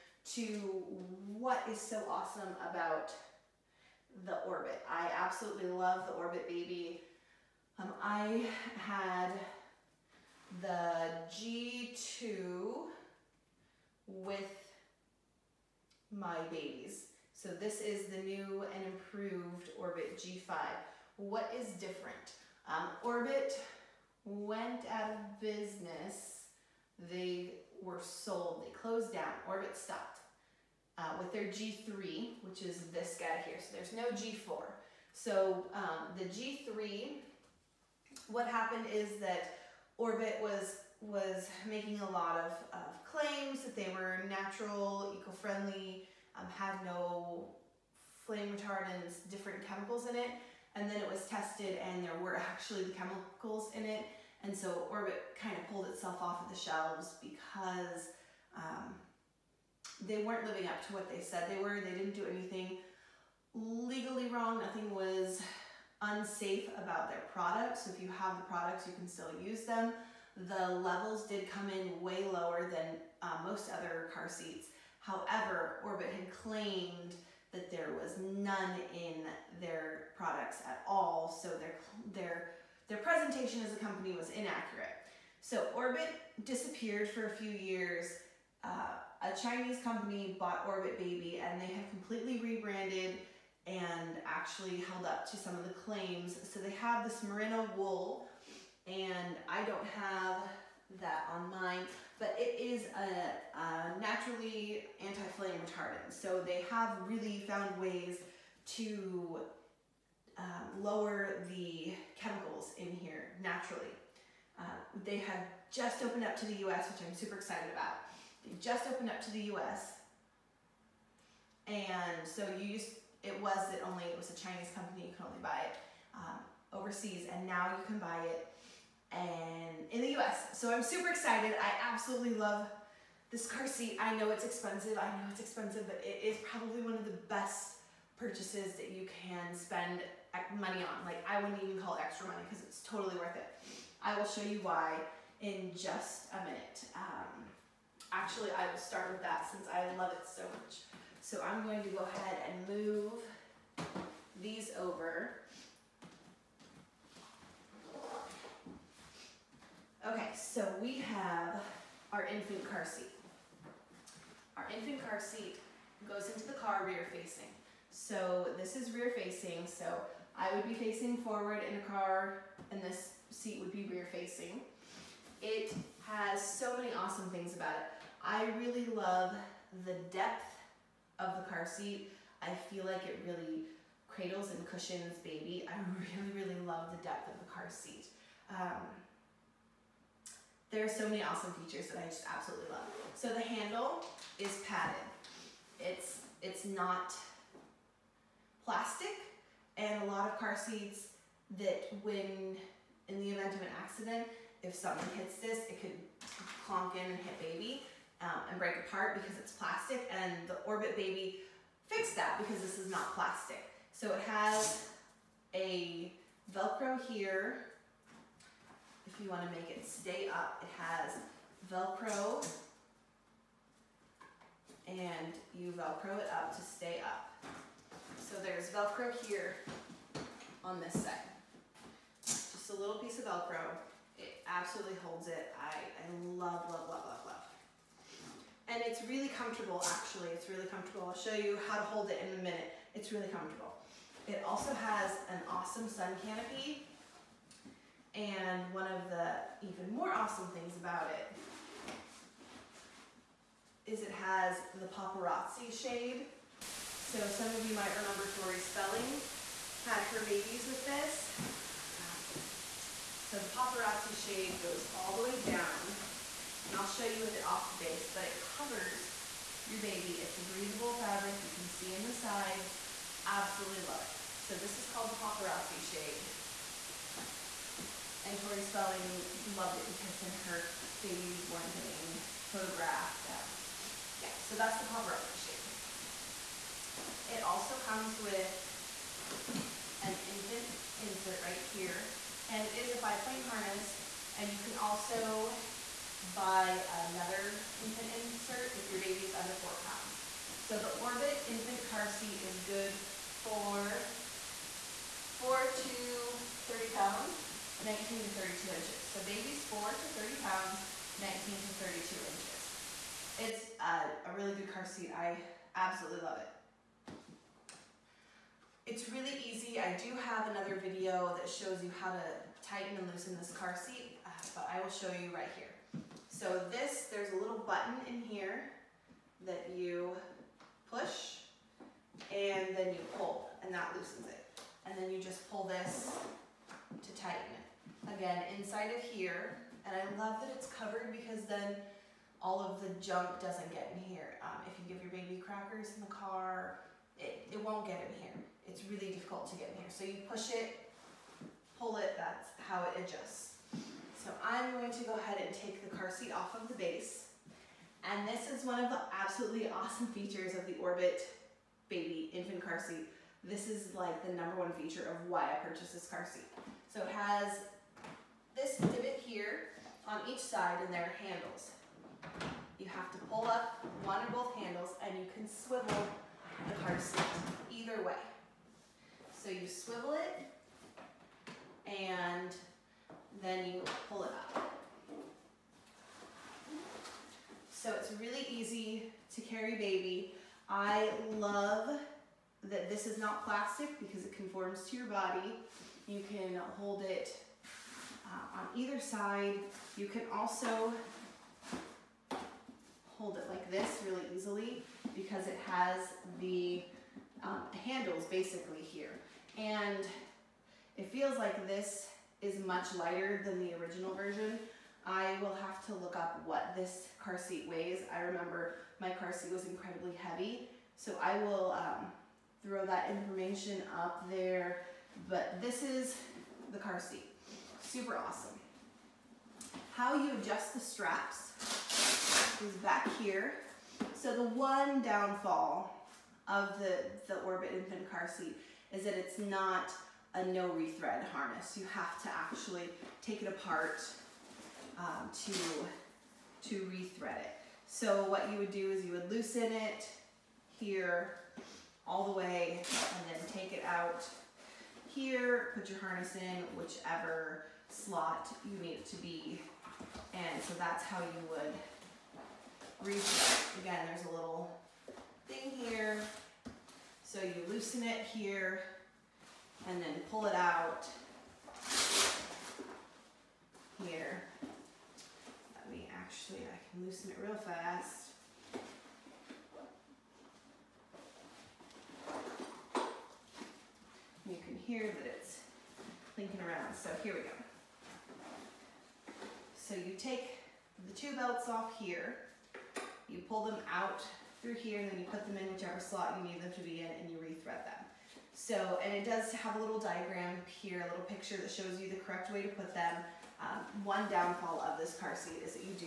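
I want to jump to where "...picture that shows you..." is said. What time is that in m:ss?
8:21.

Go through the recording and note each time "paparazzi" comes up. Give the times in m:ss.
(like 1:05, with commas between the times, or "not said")
4:14, 4:23, 4:35, 4:44.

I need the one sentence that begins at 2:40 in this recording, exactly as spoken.
Okay, so we have our infant car seat.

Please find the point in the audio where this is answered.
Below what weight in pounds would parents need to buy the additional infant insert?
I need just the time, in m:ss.
4:59.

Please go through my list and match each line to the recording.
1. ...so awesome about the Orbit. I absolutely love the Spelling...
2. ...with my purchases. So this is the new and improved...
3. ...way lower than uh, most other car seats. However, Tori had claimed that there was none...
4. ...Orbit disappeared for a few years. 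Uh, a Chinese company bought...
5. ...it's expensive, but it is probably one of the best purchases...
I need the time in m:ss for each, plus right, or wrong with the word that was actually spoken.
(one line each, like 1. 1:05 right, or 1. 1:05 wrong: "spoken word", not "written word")
1. 0:01 wrong: "Orbit", not "Spelling"
2. 0:14 wrong: "babies", not "purchases"
3. 1:12 wrong: "Orbit", not "Tori"
4. 1:25 right
5. 2:15 right.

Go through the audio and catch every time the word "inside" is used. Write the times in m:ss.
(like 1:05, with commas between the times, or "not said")
5:38.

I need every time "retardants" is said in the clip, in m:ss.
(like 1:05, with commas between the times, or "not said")
0:48, 1:45.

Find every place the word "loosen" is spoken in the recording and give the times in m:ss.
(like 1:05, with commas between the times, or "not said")
5:23, 5:33, 7:29, 7:47, 7:57.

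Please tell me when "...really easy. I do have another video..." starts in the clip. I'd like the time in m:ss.
5:19.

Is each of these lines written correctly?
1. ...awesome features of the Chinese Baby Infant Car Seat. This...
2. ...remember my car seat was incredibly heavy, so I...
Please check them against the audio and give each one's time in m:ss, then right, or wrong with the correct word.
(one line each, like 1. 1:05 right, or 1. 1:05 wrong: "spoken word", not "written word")
1. 5:59 wrong: "Orbit", not "Chinese"
2. 6:58 right.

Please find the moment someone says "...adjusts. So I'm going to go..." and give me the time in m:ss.
5:53.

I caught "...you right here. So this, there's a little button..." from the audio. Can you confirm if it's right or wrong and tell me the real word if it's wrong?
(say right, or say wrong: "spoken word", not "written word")
right.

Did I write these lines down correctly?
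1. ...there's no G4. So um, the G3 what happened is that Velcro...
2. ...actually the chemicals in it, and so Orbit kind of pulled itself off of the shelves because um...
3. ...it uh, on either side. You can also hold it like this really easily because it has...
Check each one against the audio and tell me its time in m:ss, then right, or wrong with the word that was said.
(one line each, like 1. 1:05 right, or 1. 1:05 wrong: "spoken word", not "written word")
1. 0:33 wrong: "Orbit", not "Velcro"
2. 0:52 right
3. 6:37 right.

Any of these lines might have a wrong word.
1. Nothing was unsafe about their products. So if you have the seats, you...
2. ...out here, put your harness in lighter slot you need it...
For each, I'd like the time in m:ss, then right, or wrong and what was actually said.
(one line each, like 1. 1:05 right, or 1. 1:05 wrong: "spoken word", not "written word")
1. 1:04 wrong: "products", not "seats"
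2. 7:33 wrong: "whichever", not "lighter".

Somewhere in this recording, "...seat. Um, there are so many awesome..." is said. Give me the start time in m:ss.
3:07.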